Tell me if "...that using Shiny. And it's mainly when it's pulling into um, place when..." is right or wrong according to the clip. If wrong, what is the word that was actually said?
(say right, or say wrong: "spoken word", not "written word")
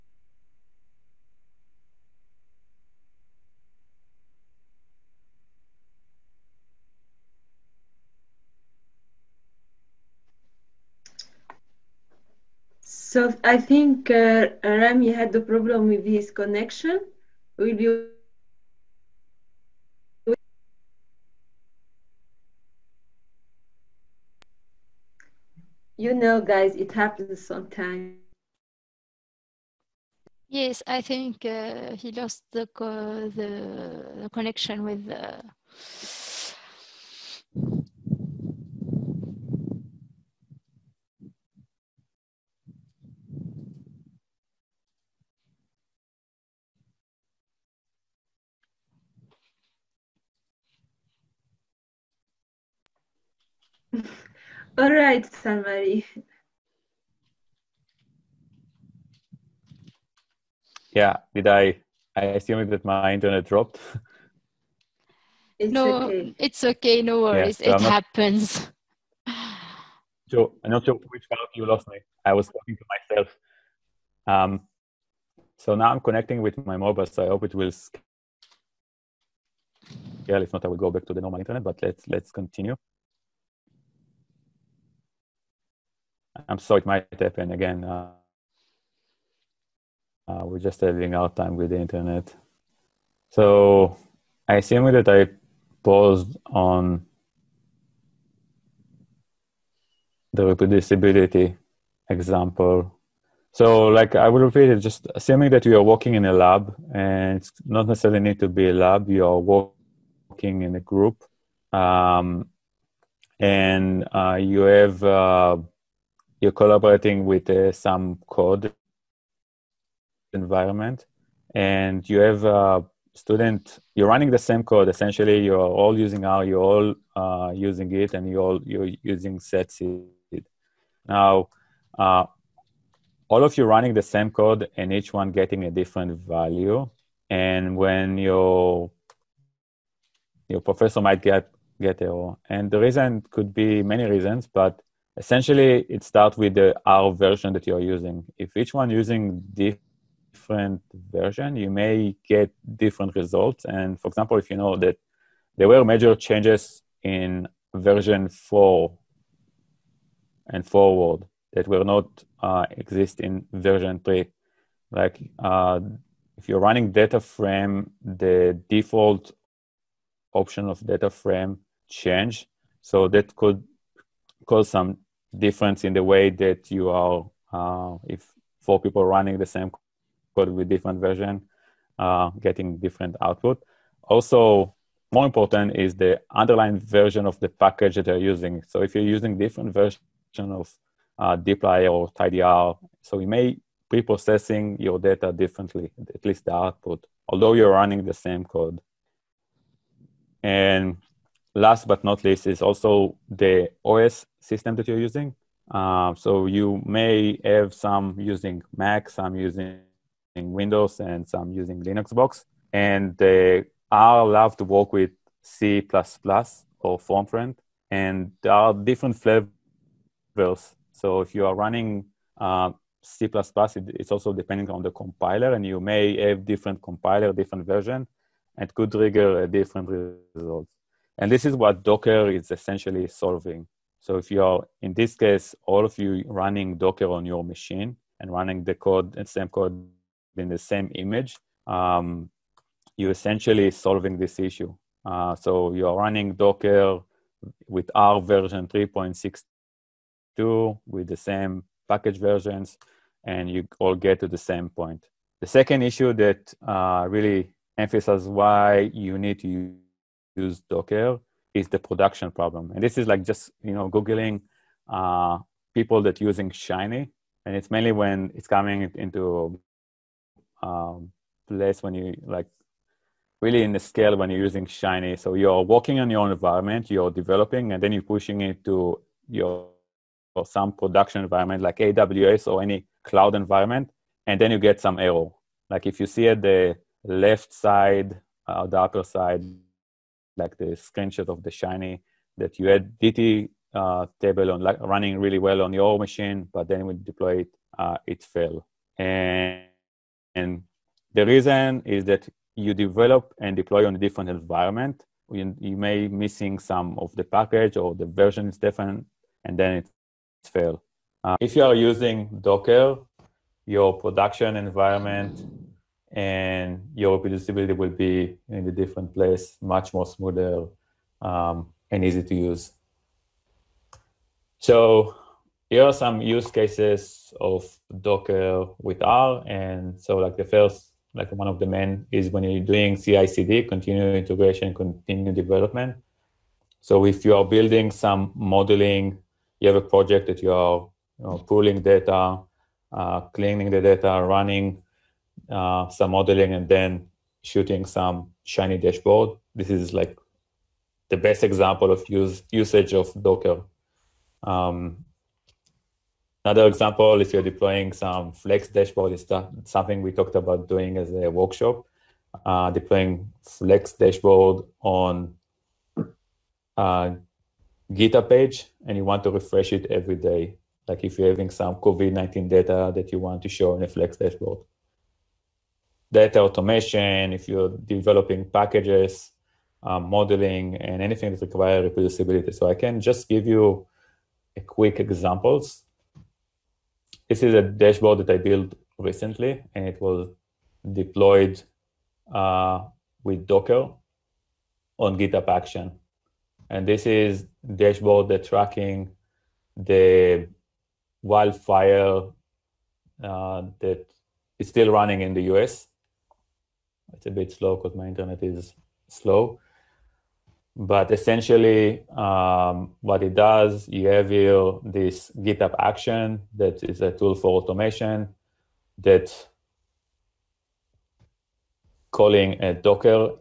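wrong: "coming", not "pulling".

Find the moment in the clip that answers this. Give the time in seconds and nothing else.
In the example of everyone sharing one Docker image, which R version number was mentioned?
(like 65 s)
248 s.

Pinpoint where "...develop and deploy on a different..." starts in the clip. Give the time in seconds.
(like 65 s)
302 s.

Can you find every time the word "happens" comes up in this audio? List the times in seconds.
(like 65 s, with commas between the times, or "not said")
26 s, 67 s, 87 s.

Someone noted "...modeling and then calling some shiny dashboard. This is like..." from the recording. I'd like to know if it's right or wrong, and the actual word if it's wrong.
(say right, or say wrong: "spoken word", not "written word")
wrong: "shooting", not "calling".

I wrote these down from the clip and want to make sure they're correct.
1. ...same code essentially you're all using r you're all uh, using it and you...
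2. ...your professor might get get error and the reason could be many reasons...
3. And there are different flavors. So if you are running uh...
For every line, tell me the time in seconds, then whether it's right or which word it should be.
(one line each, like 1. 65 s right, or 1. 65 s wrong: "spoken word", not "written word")
1. 124 s right
2. 140 s right
3. 217 s right.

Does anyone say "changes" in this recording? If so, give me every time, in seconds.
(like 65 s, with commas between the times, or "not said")
156 s, 171 s.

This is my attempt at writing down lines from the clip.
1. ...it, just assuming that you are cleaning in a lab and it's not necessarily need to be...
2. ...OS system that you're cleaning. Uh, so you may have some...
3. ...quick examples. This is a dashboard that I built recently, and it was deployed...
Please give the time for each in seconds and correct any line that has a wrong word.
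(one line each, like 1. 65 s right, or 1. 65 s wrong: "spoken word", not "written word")
1. 104 s wrong: "working", not "cleaning"
2. 203 s wrong: "using", not "cleaning"
3. 384 s right.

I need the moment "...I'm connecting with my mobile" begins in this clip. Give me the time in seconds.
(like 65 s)
75 s.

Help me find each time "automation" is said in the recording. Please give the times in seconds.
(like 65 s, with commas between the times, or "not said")
376 s, 417 s.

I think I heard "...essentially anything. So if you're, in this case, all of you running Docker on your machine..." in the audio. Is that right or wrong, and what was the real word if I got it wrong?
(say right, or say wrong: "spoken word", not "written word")
wrong: "solving", not "anything".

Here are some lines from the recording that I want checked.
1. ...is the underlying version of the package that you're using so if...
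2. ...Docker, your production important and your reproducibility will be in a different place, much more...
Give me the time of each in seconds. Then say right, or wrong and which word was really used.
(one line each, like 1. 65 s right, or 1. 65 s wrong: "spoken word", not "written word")
1. 185 s right
2. 312 s wrong: "environment", not "important".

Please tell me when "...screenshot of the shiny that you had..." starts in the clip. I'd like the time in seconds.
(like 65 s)
290 s.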